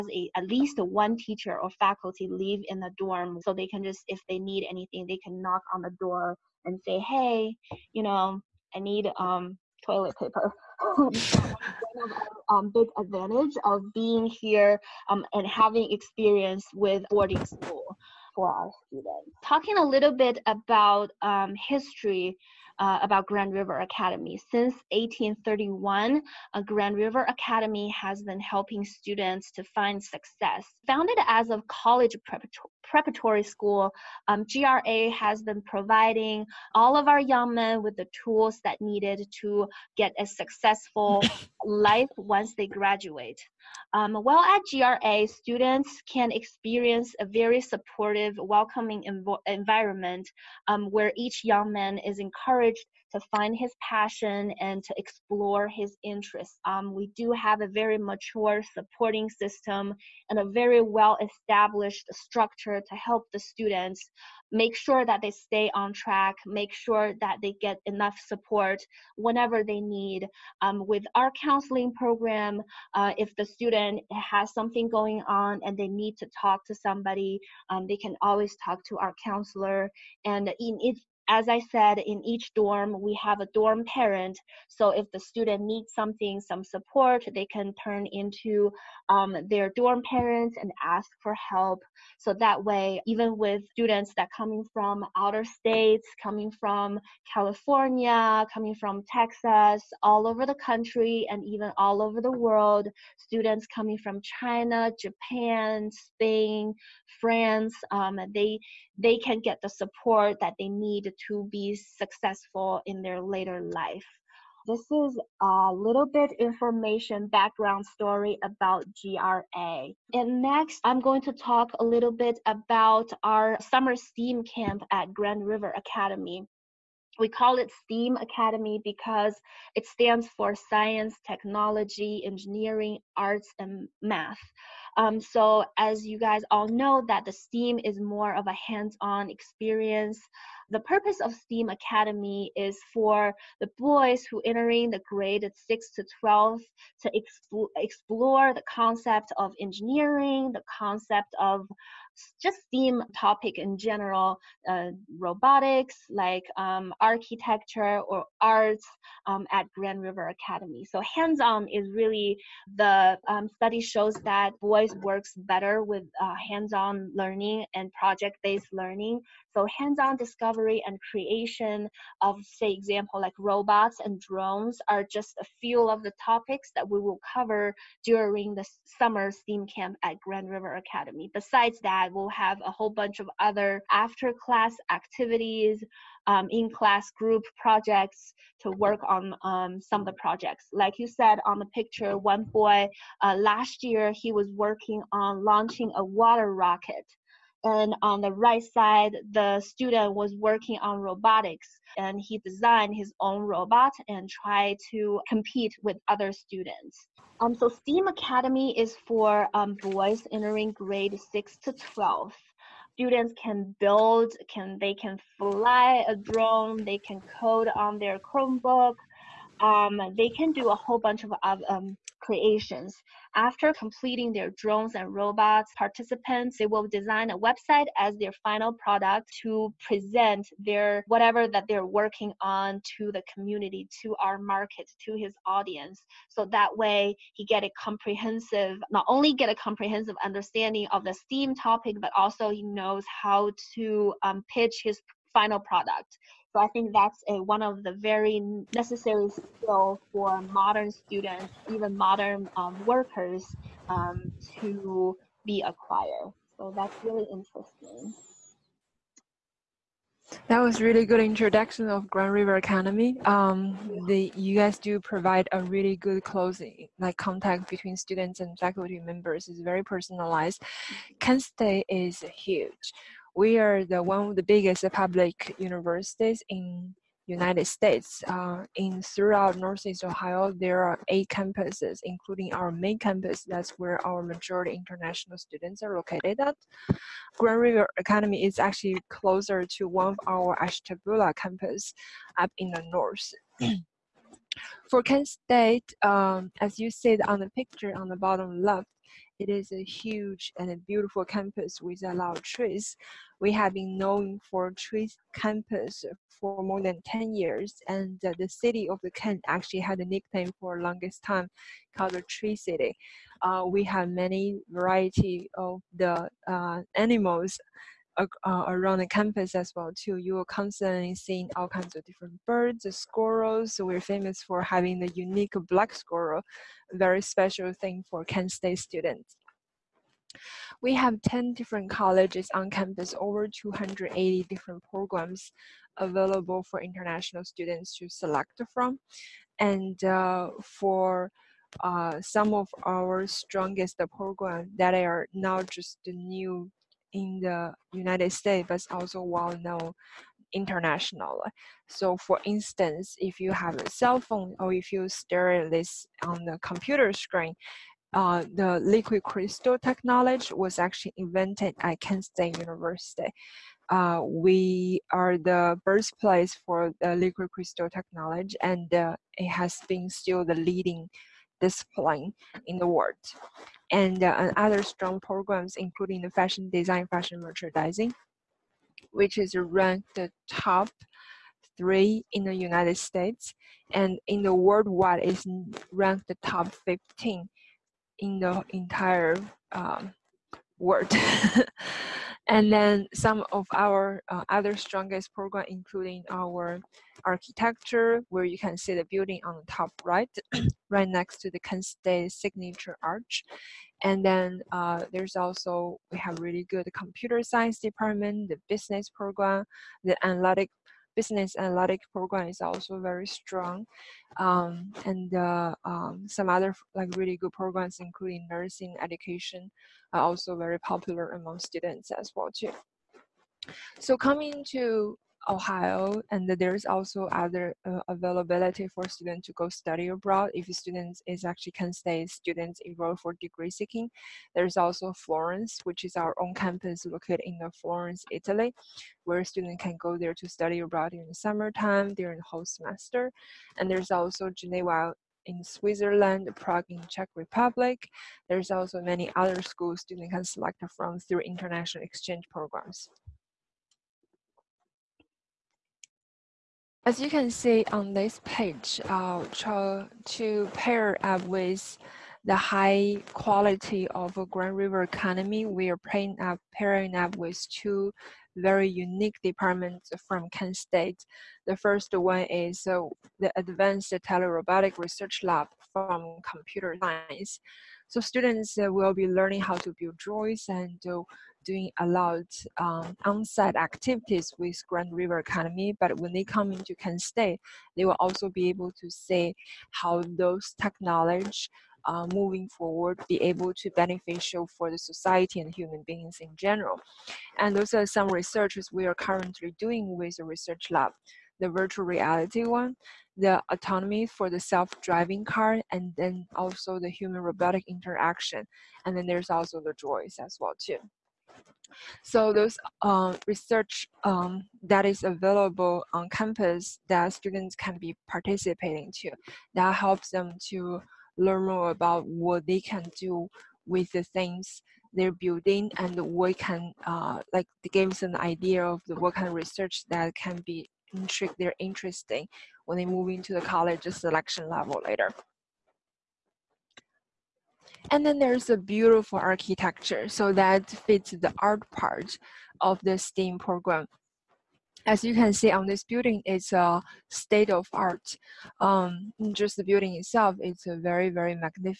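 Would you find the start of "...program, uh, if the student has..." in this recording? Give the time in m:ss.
1:11.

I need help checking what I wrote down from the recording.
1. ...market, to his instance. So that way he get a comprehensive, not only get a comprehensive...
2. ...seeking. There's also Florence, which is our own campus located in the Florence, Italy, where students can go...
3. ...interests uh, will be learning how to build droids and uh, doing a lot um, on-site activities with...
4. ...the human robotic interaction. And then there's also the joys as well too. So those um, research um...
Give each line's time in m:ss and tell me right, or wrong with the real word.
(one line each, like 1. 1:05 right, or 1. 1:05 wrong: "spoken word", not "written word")
1. 3:54 wrong: "audience", not "instance"
2. 7:13 right
3. 7:58 wrong: "students", not "interests"
4. 8:26 right.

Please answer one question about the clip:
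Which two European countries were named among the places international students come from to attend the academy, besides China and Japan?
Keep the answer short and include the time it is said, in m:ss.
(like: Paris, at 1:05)
Spain, France, at 1:45.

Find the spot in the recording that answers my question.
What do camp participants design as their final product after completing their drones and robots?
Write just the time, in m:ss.
3:47.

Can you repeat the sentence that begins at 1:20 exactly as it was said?
And in, as I said, in each dorm, we have a dorm parent.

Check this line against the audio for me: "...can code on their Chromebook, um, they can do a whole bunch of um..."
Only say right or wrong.
right.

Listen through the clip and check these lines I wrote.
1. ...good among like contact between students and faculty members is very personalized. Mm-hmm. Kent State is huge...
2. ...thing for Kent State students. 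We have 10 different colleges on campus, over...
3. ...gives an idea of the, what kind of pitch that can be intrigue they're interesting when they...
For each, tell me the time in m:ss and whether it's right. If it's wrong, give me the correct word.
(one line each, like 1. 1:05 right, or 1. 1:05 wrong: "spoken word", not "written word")
1. 4:25 wrong: "closing", not "among"
2. 5:27 right
3. 8:47 wrong: "research", not "pitch".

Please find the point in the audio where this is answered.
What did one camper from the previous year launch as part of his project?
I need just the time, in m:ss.
3:16.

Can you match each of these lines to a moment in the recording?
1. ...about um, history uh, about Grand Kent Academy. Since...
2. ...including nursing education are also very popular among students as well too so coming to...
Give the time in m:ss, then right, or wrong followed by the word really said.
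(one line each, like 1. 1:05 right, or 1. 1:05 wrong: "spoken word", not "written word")
1. 0:20 wrong: "River", not "Kent"
2. 6:57 right.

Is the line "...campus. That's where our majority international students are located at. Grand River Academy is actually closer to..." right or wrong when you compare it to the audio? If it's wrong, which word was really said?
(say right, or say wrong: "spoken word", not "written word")
right.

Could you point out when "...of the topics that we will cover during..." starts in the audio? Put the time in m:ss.
2:55.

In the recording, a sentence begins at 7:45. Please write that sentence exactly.
We are pairing up, pairing up with two very unique departments from Kent State.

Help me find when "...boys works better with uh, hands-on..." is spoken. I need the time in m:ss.
2:44.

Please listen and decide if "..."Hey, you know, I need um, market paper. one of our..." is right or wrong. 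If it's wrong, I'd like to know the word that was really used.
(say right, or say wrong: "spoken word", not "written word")
wrong: "toilet", not "market".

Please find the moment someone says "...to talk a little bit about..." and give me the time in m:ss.
2:01.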